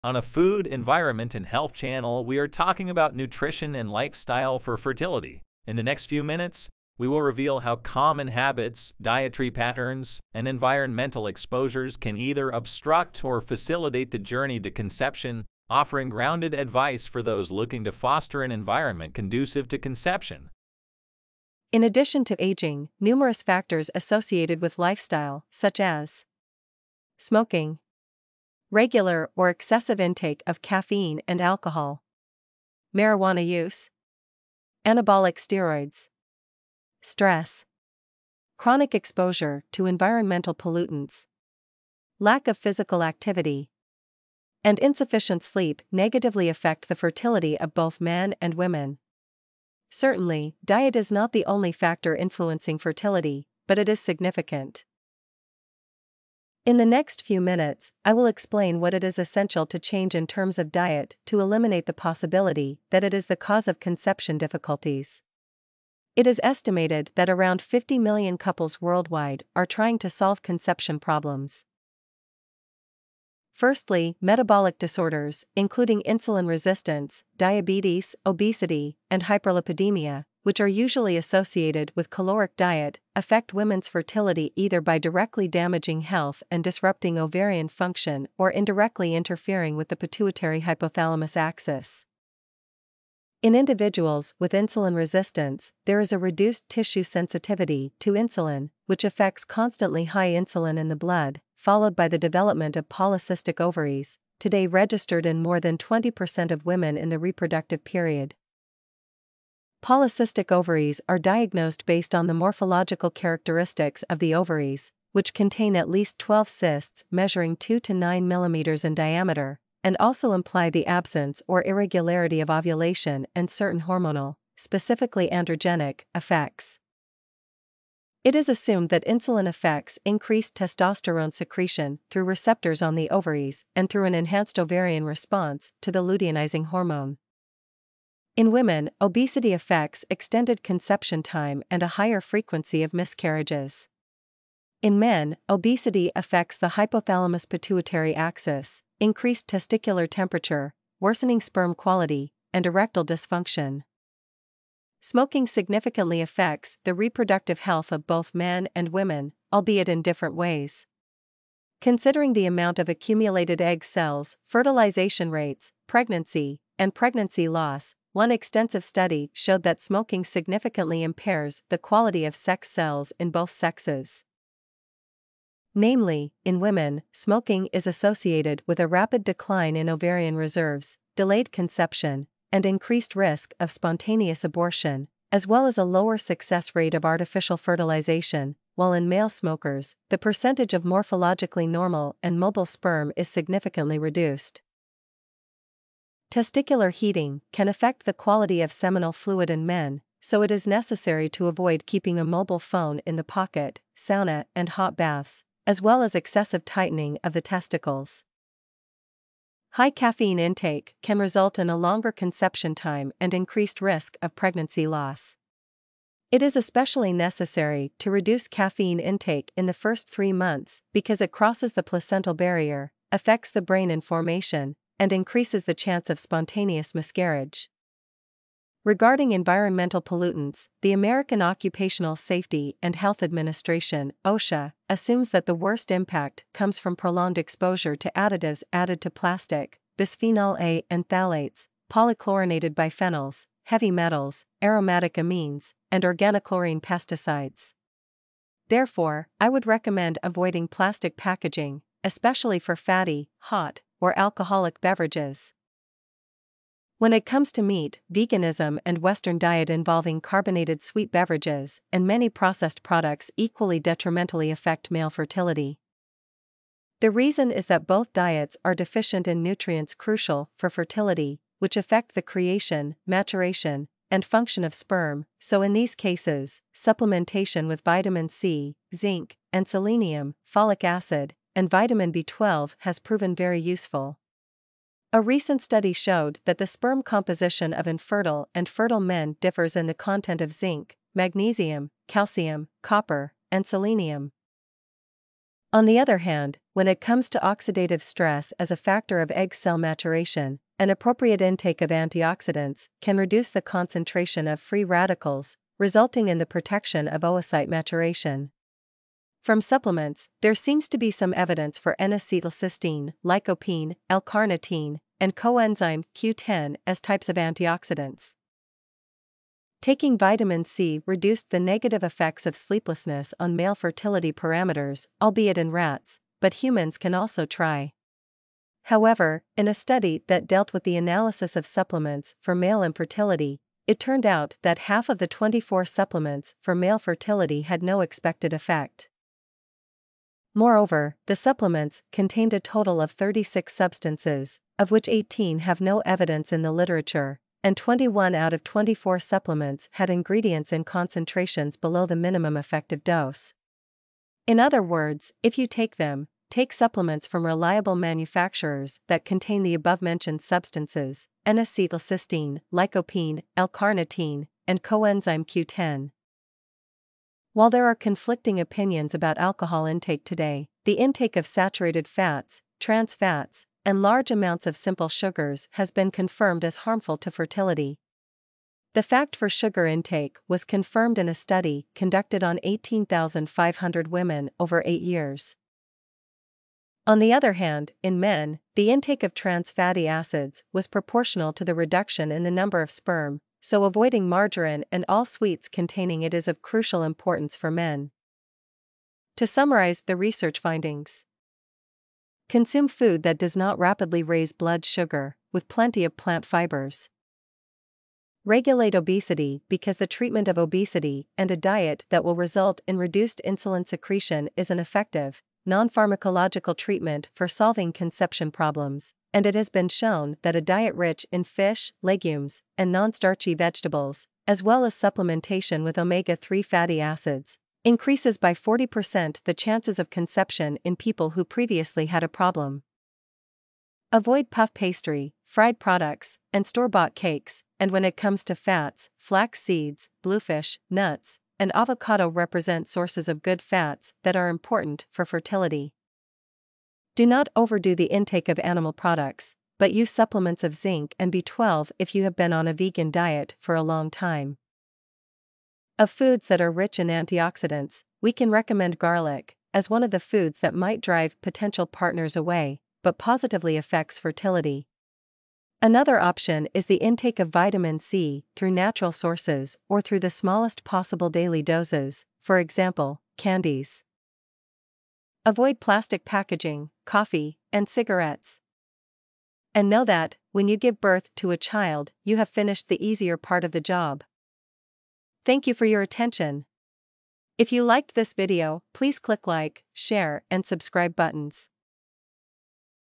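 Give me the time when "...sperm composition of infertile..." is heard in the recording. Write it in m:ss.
4:46.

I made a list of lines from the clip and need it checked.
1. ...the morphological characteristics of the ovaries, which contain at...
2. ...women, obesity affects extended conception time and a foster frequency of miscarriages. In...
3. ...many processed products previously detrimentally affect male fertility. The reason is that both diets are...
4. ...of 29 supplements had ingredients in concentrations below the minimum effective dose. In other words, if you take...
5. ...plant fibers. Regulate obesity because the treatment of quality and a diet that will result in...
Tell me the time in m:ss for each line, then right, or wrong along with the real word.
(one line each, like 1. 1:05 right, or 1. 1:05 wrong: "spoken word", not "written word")
1. 1:52 right
2. 2:18 wrong: "higher", not "foster"
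3. 4:22 wrong: "equally", not "previously"
4. 5:48 wrong: "24", not "29"
5. 6:46 wrong: "obesity", not "quality".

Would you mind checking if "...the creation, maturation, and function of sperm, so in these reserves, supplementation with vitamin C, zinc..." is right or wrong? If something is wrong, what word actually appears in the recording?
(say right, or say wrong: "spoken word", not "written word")
wrong: "cases", not "reserves".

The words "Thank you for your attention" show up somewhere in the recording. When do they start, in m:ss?
8:05.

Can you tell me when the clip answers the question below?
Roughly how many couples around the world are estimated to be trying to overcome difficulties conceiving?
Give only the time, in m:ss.
1:07.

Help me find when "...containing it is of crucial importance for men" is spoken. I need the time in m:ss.
6:35.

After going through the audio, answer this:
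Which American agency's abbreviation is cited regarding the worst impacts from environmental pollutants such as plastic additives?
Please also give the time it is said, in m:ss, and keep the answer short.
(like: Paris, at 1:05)
OSHA, at 3:54.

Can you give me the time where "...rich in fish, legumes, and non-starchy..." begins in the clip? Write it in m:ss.
7:00.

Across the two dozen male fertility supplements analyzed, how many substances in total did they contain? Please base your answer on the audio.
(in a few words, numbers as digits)
36.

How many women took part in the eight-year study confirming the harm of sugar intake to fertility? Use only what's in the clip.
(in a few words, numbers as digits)
18,500.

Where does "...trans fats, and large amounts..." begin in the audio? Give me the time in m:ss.
6:12.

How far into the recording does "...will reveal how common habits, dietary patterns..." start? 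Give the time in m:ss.
0:07.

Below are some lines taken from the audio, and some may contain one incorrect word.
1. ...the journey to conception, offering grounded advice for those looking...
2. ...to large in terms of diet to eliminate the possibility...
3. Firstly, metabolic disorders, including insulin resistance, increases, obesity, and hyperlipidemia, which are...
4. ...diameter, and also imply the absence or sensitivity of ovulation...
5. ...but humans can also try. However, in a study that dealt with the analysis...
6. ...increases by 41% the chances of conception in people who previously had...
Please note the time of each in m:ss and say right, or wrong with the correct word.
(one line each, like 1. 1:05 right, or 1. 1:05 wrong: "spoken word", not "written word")
1. 0:14 right
2. 0:59 wrong: "change", not "large"
3. 1:13 wrong: "diabetes", not "increases"
4. 1:58 wrong: "irregularity", not "sensitivity"
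5. 5:26 right
6. 7:07 wrong: "40", not "41".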